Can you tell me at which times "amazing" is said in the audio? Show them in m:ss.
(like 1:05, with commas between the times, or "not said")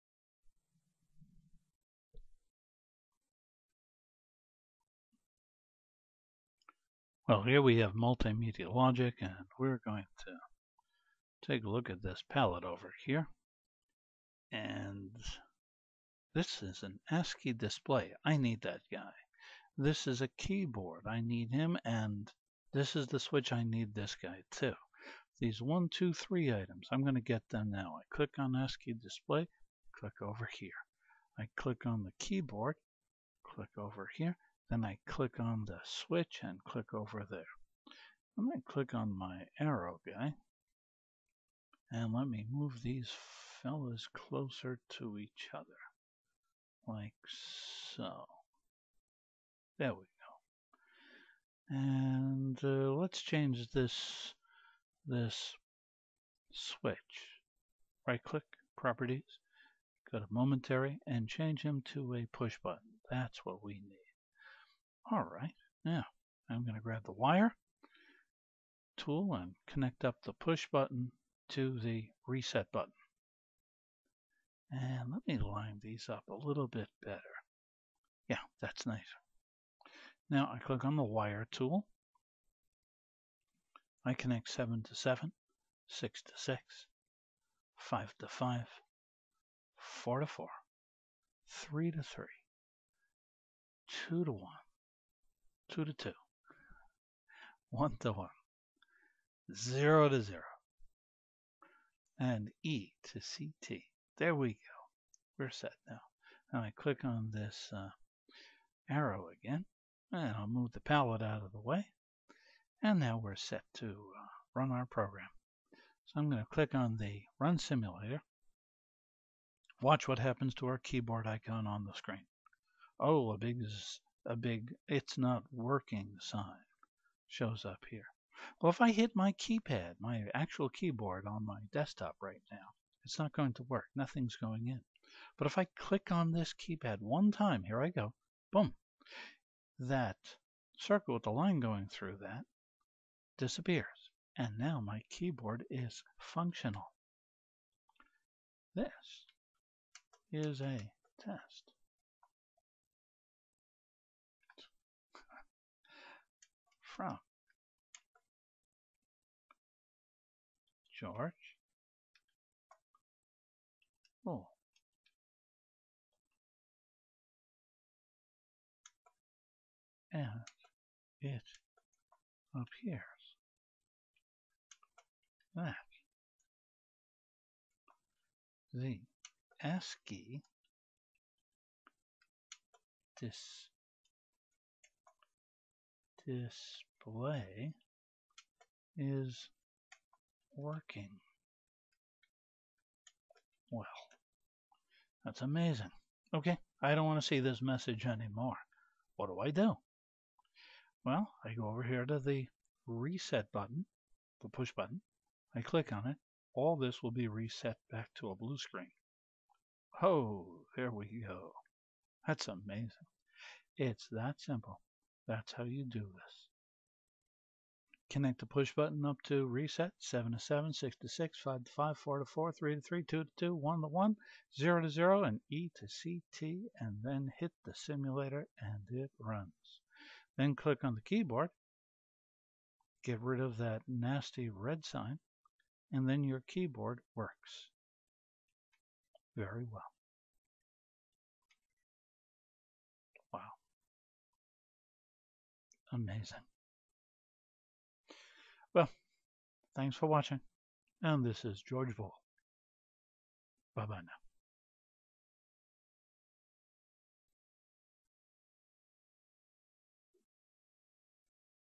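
3:15, 3:32, 4:05.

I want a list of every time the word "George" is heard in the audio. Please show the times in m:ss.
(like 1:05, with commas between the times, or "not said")
2:40, 4:11.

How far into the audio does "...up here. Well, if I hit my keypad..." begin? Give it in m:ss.
2:07.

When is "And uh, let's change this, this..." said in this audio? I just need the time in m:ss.
0:51.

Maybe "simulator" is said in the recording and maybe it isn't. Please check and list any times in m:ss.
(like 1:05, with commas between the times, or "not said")
1:57, 3:47.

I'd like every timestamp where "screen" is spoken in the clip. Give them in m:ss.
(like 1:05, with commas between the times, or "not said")
2:01, 3:28.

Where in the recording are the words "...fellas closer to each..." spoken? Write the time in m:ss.
0:43.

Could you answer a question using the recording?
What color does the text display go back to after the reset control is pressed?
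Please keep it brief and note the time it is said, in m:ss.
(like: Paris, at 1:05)
blue, at 3:28.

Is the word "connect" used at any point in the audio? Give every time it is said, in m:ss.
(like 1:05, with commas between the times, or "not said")
1:09, 1:24, 3:38.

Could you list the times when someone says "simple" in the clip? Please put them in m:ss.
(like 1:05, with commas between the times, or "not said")
3:34.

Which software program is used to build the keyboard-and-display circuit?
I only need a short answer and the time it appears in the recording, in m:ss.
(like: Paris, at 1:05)
Multimedia Logic, at 0:07.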